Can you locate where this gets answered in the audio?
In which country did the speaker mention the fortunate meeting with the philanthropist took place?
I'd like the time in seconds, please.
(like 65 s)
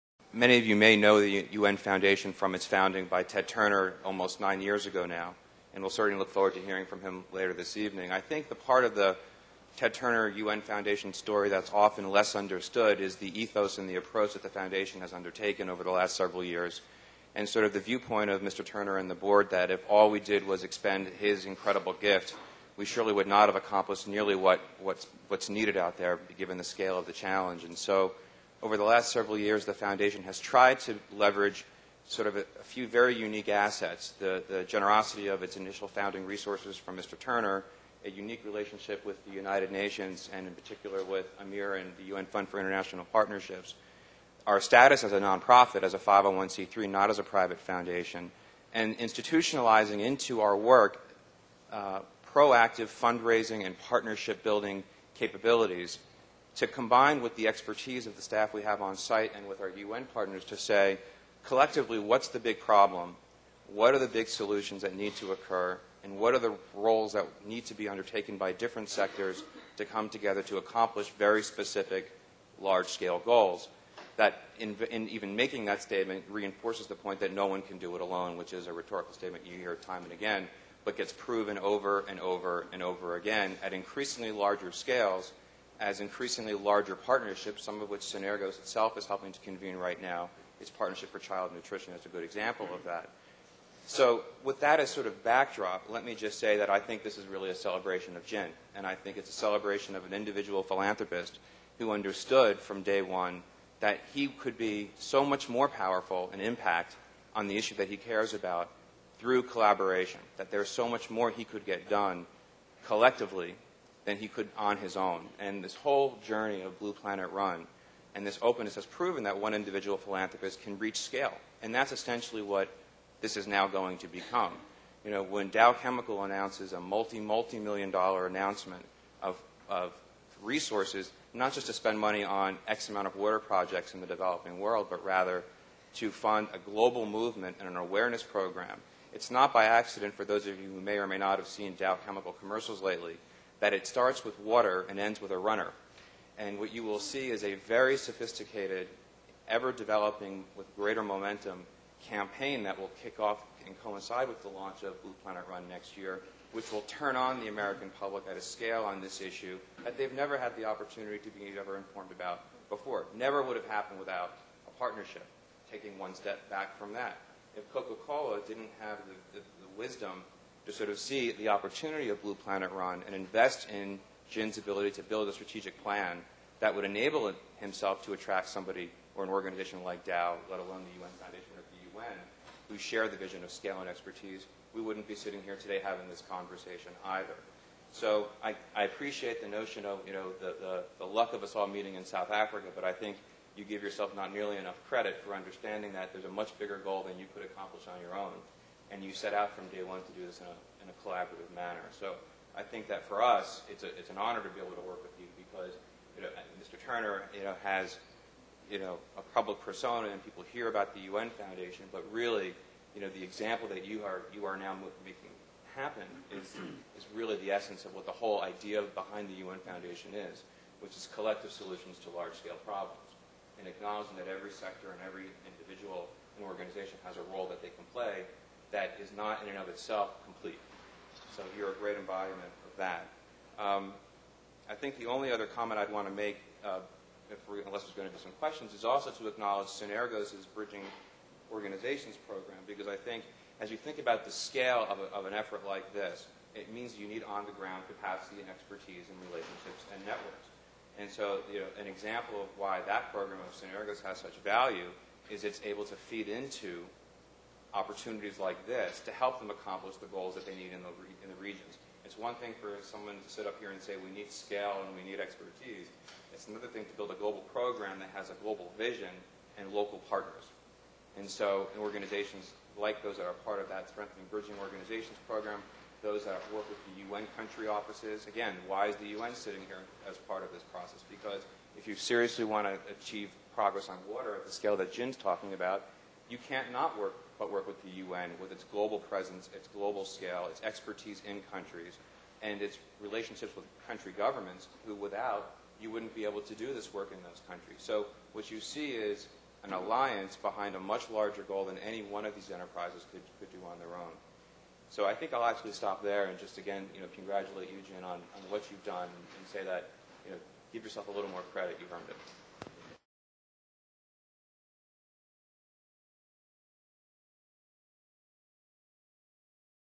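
192 s.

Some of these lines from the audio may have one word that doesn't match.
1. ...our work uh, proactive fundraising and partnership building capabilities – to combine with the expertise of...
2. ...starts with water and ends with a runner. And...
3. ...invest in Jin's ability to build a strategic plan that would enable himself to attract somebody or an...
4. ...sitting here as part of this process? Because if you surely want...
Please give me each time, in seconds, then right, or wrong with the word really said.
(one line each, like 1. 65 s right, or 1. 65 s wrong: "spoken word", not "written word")
1. 50 s right
2. 143 s right
3. 173 s right
4. 279 s wrong: "seriously", not "surely".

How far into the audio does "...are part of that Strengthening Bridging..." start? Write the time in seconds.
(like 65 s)
273 s.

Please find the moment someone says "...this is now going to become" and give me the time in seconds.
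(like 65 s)
123 s.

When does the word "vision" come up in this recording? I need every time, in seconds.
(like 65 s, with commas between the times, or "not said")
183 s, 268 s.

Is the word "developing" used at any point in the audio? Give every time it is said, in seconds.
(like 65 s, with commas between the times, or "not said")
134 s, 149 s.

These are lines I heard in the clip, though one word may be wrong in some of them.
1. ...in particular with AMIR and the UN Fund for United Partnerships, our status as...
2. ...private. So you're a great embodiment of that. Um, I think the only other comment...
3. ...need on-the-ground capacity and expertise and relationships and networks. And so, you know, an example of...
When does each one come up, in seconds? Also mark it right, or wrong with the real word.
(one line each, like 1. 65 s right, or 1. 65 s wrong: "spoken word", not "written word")
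1. 40 s wrong: "International", not "United"
2. 230 s wrong: "complete", not "private"
3. 247 s right.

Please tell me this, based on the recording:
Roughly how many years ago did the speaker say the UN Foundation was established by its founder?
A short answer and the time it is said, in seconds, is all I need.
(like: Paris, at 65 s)
almost 9 years, at 4 s.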